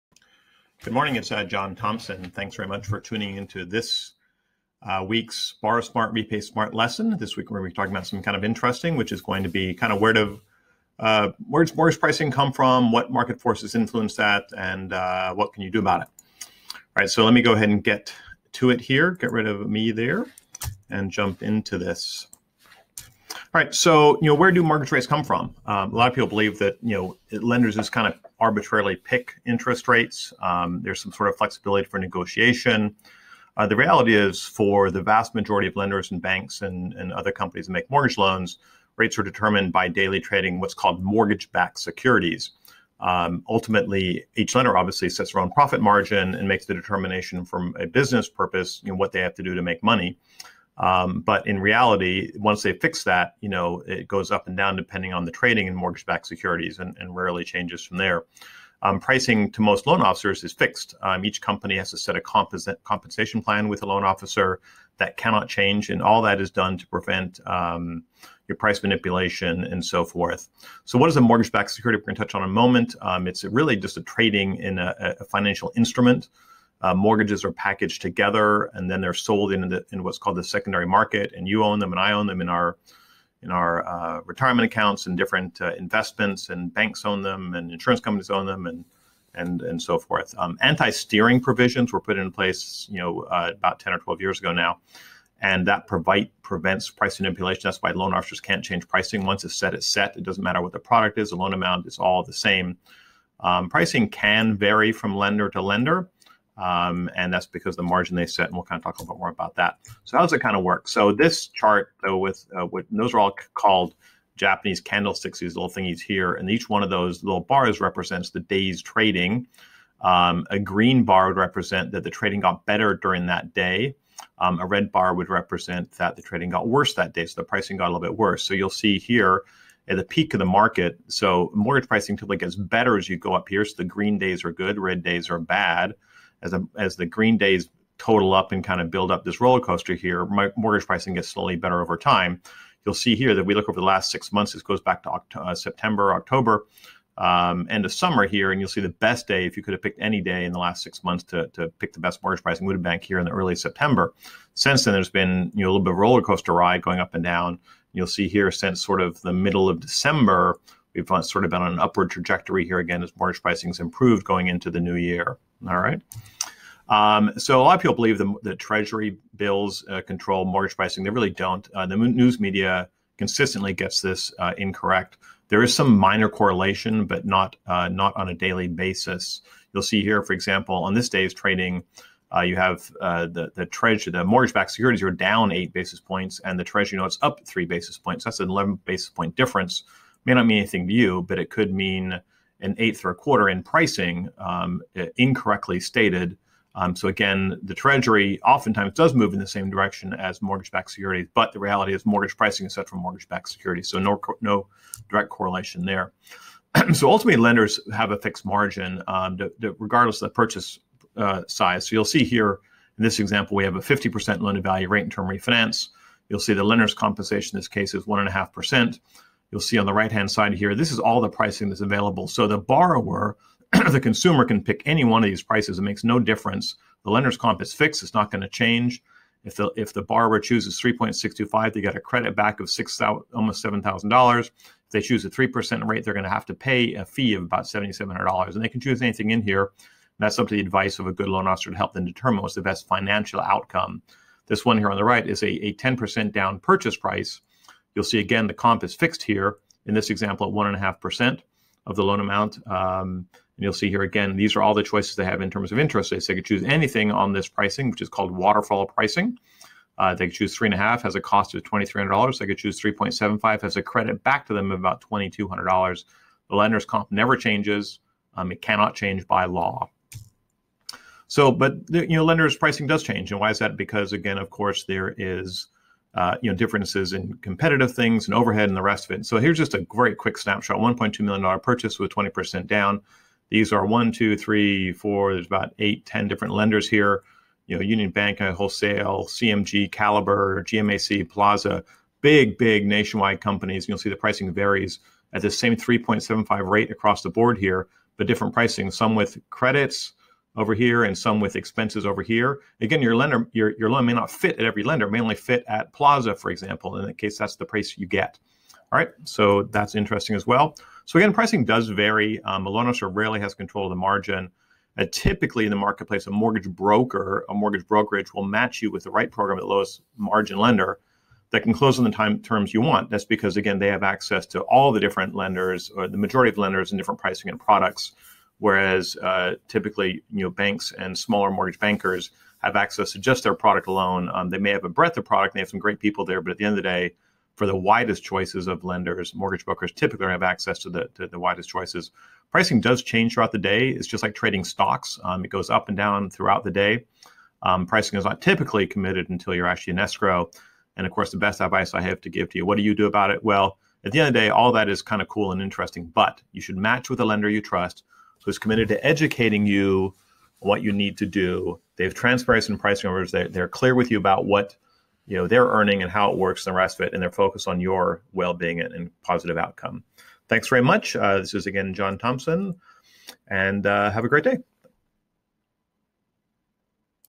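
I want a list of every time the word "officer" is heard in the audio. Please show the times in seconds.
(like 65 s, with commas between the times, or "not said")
60 s, 64 s, 98 s, 241 s, 312 s.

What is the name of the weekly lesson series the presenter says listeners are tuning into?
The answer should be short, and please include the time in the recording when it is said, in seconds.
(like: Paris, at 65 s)
Borrow Smart, Repay Smart, at 5 s.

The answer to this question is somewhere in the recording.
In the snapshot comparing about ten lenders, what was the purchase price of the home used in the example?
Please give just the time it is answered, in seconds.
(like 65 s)
280 s.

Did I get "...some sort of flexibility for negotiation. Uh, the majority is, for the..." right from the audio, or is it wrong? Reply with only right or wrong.
wrong.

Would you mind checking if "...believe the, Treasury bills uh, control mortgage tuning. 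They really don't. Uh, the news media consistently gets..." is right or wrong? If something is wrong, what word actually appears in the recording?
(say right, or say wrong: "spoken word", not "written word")
wrong: "pricing", not "tuning".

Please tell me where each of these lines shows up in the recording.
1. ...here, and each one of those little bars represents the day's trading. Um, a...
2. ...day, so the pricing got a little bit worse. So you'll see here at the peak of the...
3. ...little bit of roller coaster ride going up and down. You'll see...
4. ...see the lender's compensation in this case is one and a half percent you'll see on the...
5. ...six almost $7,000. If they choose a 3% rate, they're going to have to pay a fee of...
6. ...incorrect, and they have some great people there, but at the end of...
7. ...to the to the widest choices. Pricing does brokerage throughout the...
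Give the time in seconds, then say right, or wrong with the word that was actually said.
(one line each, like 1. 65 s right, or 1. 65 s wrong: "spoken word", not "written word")
1. 116 s right
2. 127 s right
3. 155 s right
4. 216 s right
5. 232 s right
6. 335 s wrong: "product", not "incorrect"
7. 340 s wrong: "change", not "brokerage".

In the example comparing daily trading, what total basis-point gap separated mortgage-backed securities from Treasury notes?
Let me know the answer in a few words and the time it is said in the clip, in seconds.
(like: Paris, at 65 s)
11 basis points, at 188 s.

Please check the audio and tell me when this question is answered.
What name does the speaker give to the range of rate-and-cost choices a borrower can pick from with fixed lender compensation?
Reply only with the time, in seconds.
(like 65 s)
258 s.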